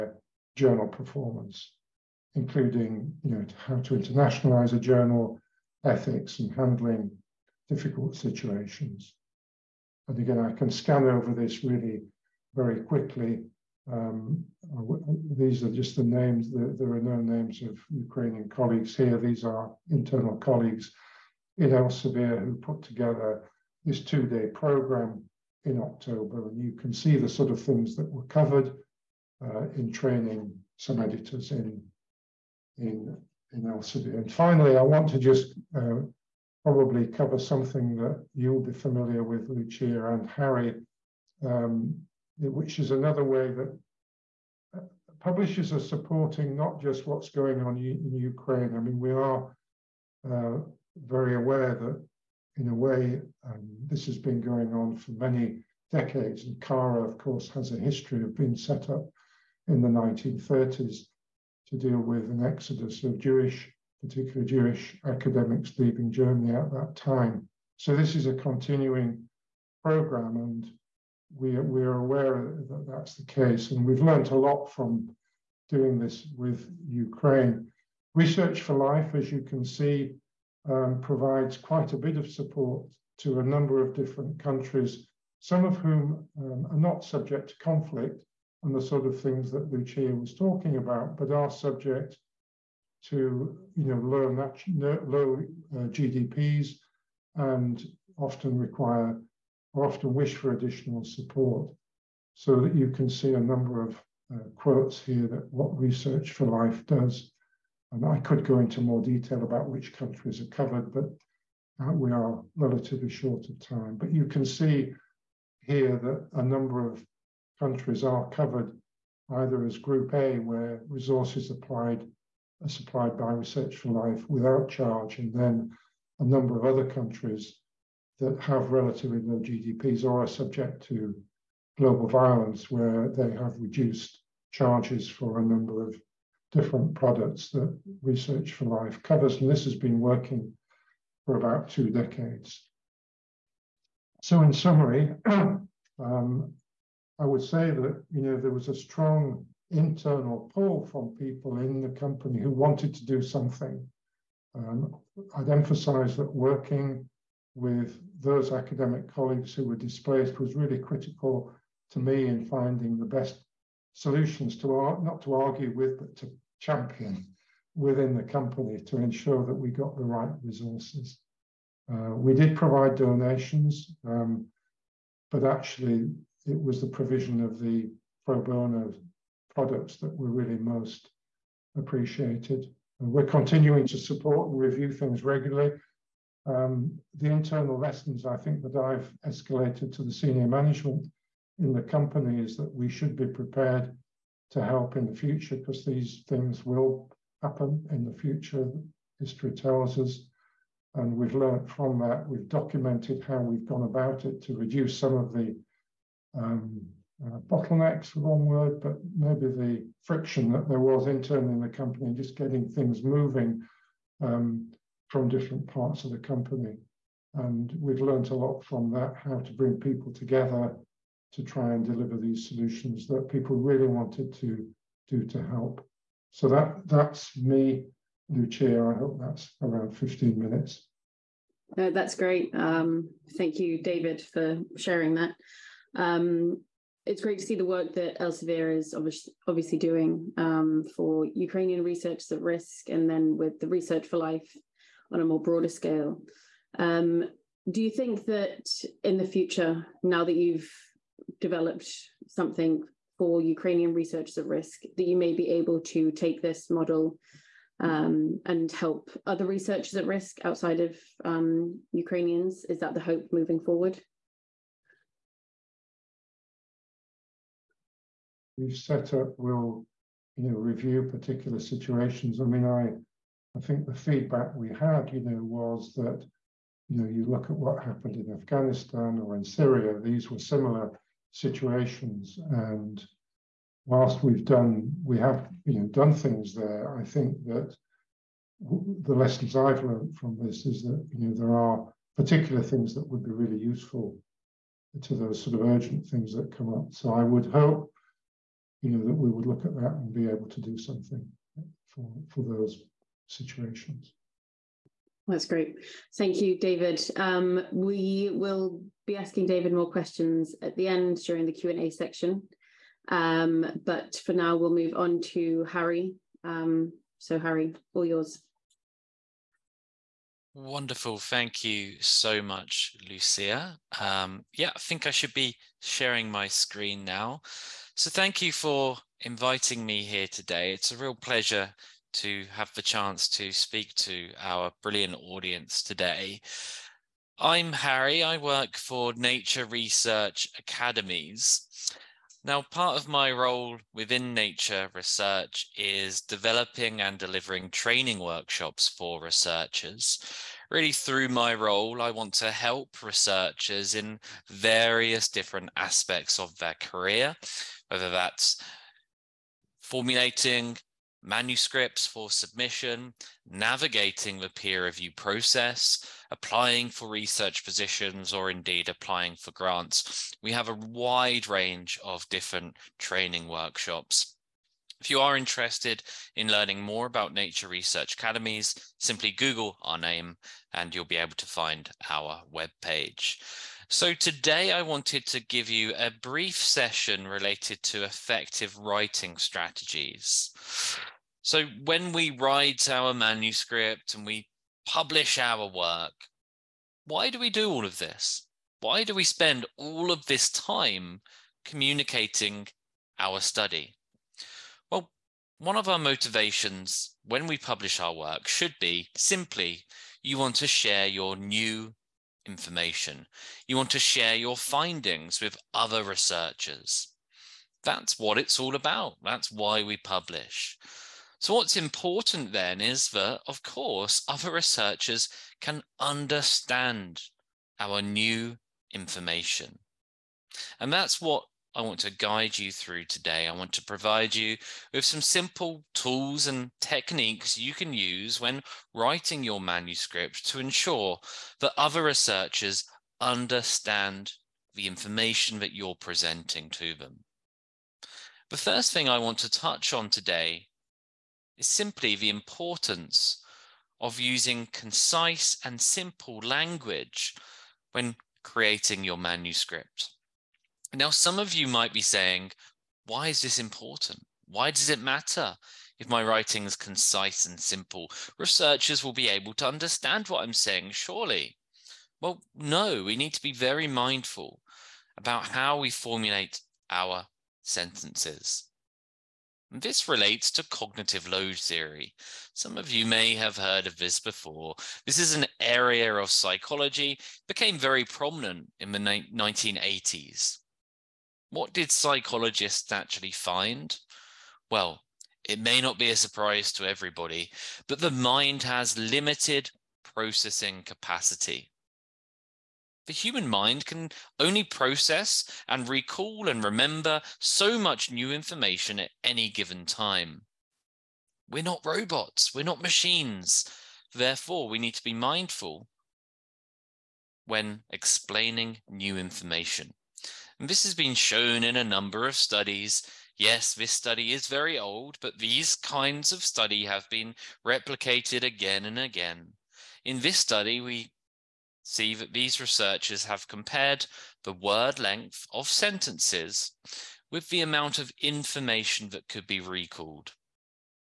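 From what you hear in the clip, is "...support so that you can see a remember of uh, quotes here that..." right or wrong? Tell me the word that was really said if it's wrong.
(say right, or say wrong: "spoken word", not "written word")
wrong: "number", not "remember".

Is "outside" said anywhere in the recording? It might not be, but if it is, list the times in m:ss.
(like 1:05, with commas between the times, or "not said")
4:20.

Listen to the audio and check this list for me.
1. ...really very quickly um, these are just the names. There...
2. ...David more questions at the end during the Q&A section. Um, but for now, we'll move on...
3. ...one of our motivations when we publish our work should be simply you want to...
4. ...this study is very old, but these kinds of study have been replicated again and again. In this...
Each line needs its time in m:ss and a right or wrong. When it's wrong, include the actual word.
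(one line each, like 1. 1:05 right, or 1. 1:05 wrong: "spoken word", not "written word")
1. 0:11 right
2. 5:09 right
3. 6:45 right
4. 8:43 right.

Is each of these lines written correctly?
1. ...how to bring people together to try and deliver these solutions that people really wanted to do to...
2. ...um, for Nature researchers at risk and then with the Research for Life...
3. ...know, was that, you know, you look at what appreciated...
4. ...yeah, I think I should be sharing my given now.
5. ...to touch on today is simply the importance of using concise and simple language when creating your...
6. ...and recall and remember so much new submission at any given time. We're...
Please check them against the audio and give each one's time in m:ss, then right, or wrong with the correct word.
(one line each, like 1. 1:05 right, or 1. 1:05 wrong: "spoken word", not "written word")
1. 3:39 right
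2. 4:00 wrong: "Ukrainian", not "Nature"
3. 4:35 wrong: "happened", not "appreciated"
4. 5:24 wrong: "screen", not "given"
5. 7:29 right
6. 8:25 wrong: "information", not "submission".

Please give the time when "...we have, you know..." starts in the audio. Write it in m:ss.
4:45.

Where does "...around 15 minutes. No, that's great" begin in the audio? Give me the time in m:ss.
3:49.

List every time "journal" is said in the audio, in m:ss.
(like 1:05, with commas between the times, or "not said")
0:00, 0:04.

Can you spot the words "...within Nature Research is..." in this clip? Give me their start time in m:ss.
5:43.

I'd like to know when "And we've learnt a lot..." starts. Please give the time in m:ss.
1:13.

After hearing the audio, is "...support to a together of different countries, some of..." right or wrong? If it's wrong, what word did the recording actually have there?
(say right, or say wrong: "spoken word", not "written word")
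wrong: "number", not "together".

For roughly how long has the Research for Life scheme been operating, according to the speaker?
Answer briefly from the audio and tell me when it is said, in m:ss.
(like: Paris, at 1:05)
About two decades, at 2:21.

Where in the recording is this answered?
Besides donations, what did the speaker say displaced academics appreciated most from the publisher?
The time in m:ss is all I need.
2:58.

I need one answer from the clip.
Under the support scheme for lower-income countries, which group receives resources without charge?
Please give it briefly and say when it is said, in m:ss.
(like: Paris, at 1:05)
Group A, at 1:59.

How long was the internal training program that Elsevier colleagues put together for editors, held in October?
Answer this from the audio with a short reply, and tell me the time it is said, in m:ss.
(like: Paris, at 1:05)
2 days, at 0:24.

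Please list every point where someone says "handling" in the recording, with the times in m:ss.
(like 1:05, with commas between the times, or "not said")
0:06.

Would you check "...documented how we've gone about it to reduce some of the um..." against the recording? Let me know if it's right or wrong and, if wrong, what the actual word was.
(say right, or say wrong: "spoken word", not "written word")
right.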